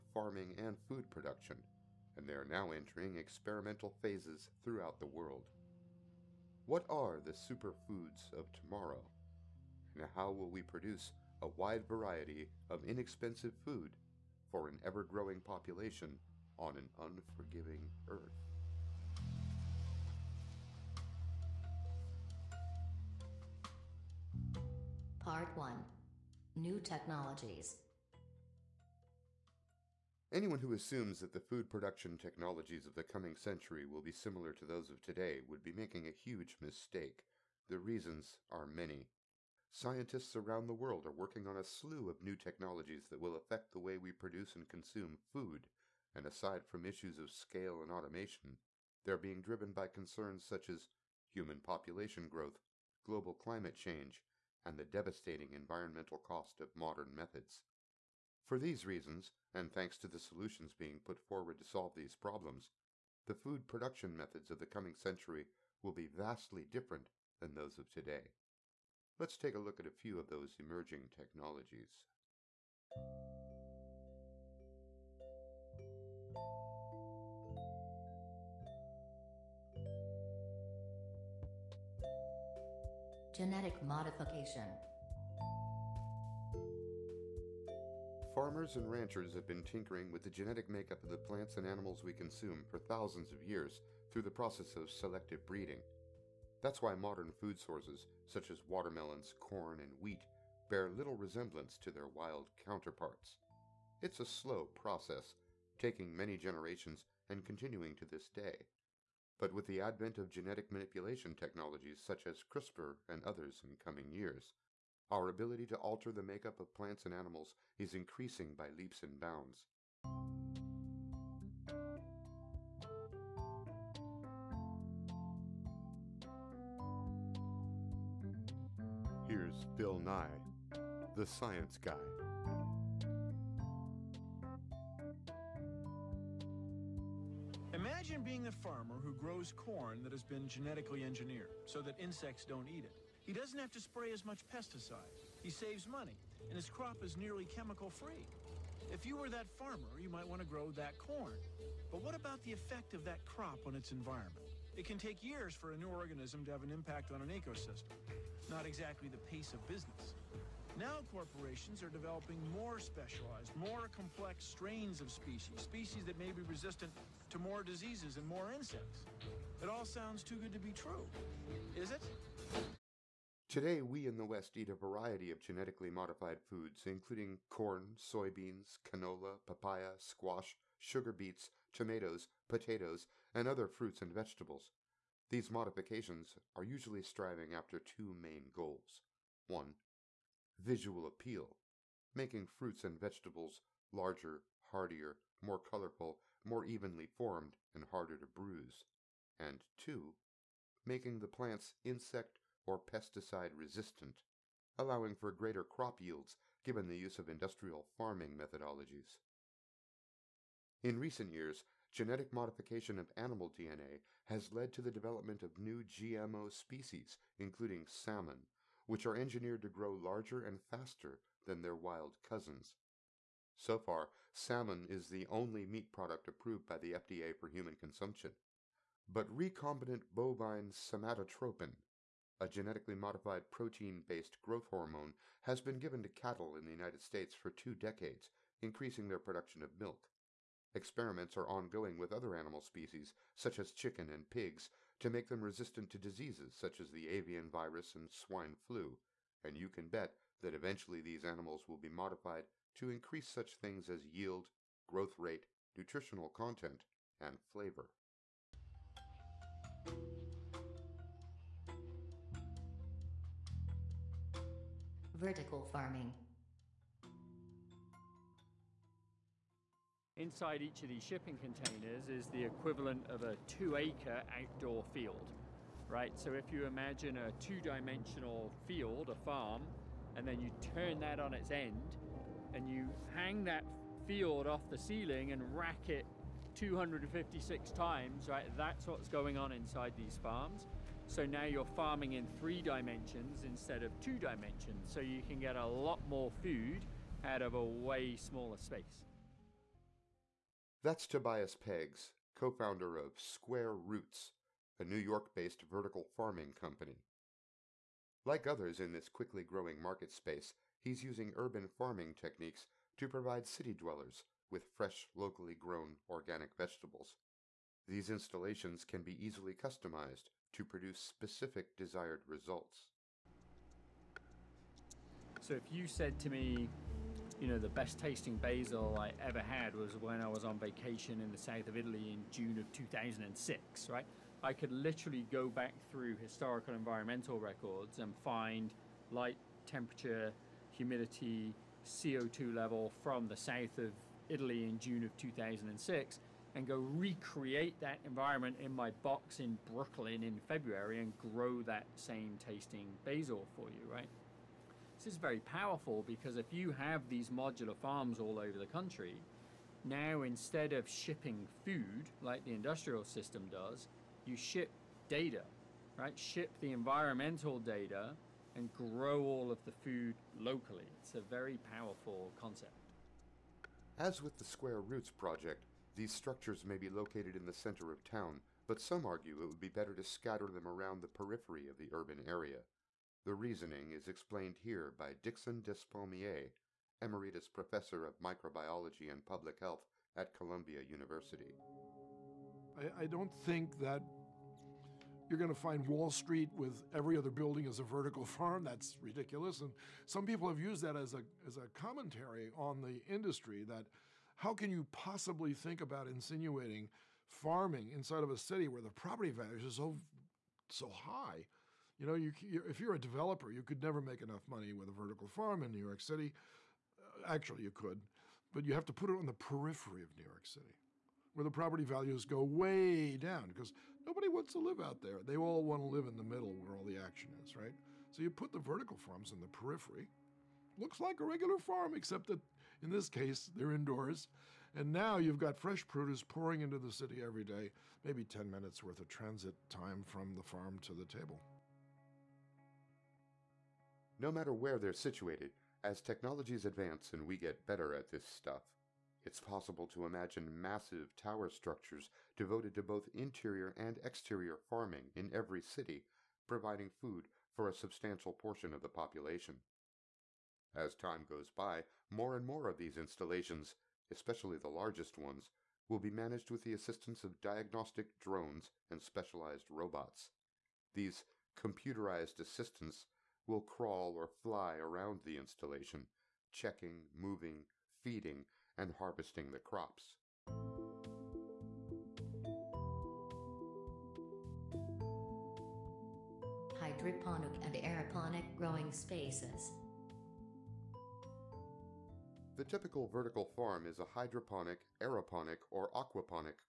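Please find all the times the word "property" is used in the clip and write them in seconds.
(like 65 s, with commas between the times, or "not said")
408 s, 421 s.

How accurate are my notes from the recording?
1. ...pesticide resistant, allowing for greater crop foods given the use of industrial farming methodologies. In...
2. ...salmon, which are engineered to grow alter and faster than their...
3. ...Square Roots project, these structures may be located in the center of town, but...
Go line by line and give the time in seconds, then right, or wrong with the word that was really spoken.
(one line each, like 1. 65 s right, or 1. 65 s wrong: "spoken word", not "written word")
1. 202 s wrong: "yields", not "foods"
2. 217 s wrong: "larger", not "alter"
3. 374 s right.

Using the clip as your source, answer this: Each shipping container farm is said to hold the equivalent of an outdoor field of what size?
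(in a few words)
2 acres.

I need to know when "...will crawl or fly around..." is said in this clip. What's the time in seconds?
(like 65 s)
473 s.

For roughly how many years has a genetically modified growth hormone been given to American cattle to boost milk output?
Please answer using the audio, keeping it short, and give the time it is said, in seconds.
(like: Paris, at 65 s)
2 decades, at 237 s.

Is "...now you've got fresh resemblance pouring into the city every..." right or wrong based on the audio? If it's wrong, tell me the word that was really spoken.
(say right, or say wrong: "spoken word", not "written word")
wrong: "produce", not "resemblance".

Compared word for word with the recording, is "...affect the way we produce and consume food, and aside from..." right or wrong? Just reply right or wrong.
right.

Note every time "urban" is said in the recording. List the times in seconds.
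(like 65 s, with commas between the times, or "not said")
311 s, 381 s.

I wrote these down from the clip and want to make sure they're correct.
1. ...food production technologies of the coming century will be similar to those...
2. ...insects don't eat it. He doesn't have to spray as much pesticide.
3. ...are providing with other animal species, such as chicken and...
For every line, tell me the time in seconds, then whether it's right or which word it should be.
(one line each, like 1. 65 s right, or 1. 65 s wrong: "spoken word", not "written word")
1. 31 s right
2. 141 s right
3. 241 s wrong: "ongoing", not "providing".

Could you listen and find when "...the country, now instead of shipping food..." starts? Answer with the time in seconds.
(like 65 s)
358 s.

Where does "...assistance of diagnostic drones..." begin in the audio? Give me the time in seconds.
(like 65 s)
466 s.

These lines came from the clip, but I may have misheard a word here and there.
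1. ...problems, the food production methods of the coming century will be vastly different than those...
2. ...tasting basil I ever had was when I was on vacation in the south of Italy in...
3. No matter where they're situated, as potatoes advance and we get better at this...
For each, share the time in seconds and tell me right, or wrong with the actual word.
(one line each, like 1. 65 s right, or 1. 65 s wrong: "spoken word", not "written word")
1. 62 s right
2. 327 s right
3. 444 s wrong: "technologies", not "potatoes".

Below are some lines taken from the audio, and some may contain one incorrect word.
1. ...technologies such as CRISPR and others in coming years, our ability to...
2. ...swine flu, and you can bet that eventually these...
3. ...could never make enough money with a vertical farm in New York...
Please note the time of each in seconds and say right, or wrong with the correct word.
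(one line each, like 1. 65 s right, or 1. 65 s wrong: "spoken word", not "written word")
1. 111 s right
2. 248 s right
3. 413 s right.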